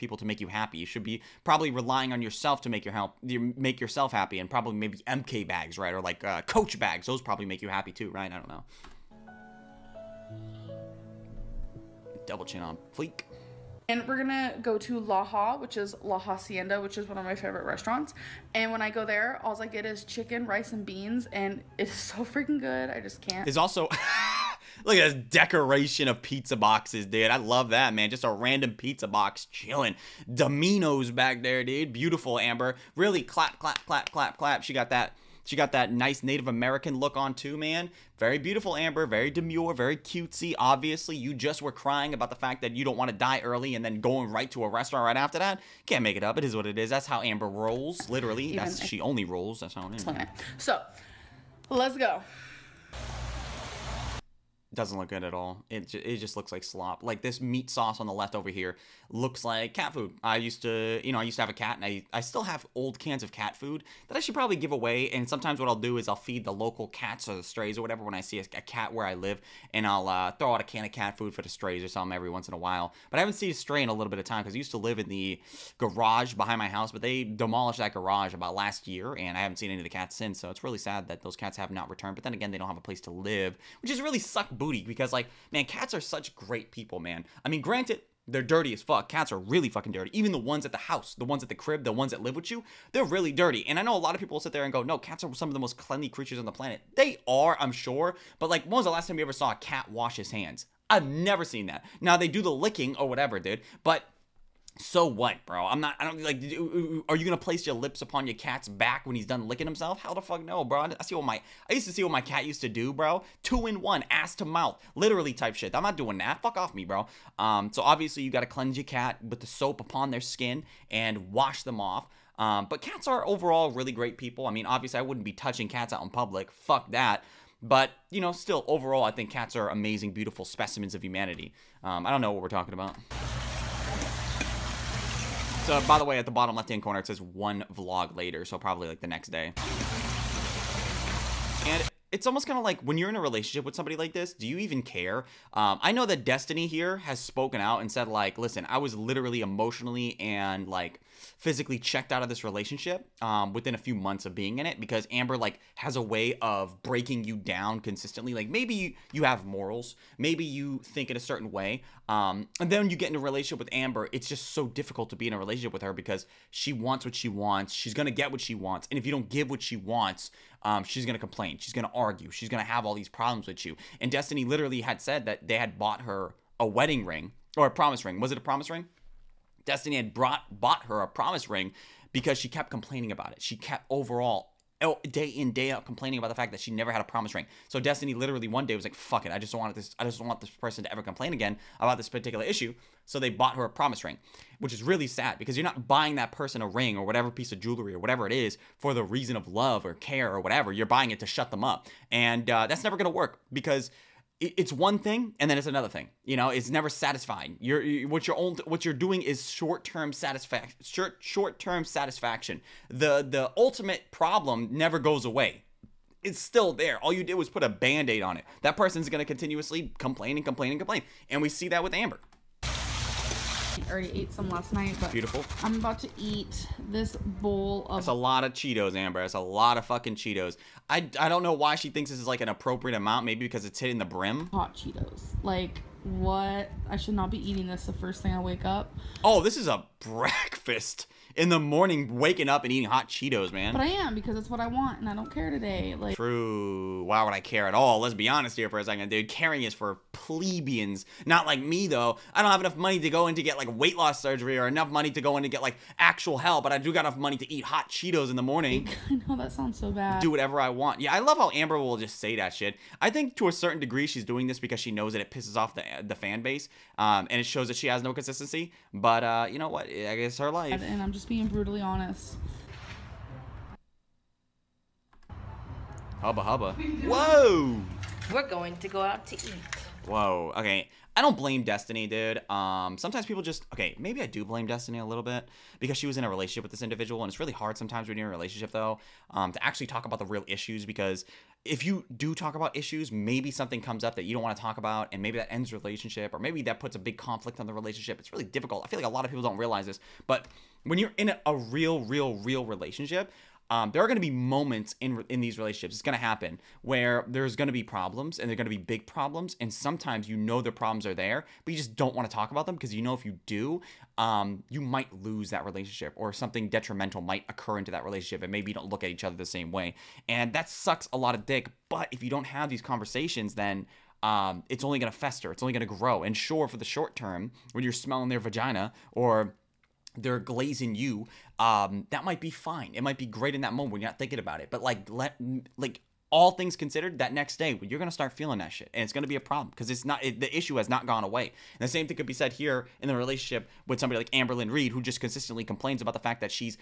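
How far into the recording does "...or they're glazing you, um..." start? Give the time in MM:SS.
05:29.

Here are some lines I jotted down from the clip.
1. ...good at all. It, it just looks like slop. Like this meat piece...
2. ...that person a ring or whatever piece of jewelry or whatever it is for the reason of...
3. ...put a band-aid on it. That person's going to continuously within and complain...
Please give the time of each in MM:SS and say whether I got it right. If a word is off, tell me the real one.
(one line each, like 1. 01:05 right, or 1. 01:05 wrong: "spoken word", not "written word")
1. 00:55 wrong: "sauce", not "piece"
2. 03:16 right
3. 03:37 wrong: "complain", not "within".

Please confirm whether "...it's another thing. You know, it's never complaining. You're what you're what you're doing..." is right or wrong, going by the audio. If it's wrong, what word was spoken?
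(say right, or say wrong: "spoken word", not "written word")
wrong: "satisfying", not "complaining".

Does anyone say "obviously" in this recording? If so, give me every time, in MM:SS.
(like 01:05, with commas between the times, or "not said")
00:40, 01:57, 02:04.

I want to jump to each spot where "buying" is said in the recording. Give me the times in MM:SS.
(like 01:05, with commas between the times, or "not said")
03:15, 03:20.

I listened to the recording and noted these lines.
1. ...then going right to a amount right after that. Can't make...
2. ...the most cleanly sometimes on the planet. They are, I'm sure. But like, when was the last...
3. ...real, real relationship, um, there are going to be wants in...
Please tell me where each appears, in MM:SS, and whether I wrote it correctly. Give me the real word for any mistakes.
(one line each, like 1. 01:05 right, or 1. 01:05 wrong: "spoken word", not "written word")
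1. 00:43 wrong: "restaurant", not "amount"
2. 01:35 wrong: "creatures", not "sometimes"
3. 05:01 wrong: "moments", not "wants".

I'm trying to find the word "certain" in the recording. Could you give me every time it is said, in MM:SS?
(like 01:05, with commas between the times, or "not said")
02:41, 04:23.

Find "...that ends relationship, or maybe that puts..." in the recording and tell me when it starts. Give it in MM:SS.
04:55.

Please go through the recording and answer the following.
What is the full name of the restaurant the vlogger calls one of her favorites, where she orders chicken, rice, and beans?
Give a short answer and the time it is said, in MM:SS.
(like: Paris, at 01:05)
La Hacienda, at 00:16.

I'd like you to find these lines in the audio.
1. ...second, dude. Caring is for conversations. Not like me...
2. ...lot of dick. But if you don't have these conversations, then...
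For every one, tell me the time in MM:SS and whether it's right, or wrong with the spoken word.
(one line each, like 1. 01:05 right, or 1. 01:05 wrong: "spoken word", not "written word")
1. 04:08 wrong: "plebeians", not "conversations"
2. 05:21 right.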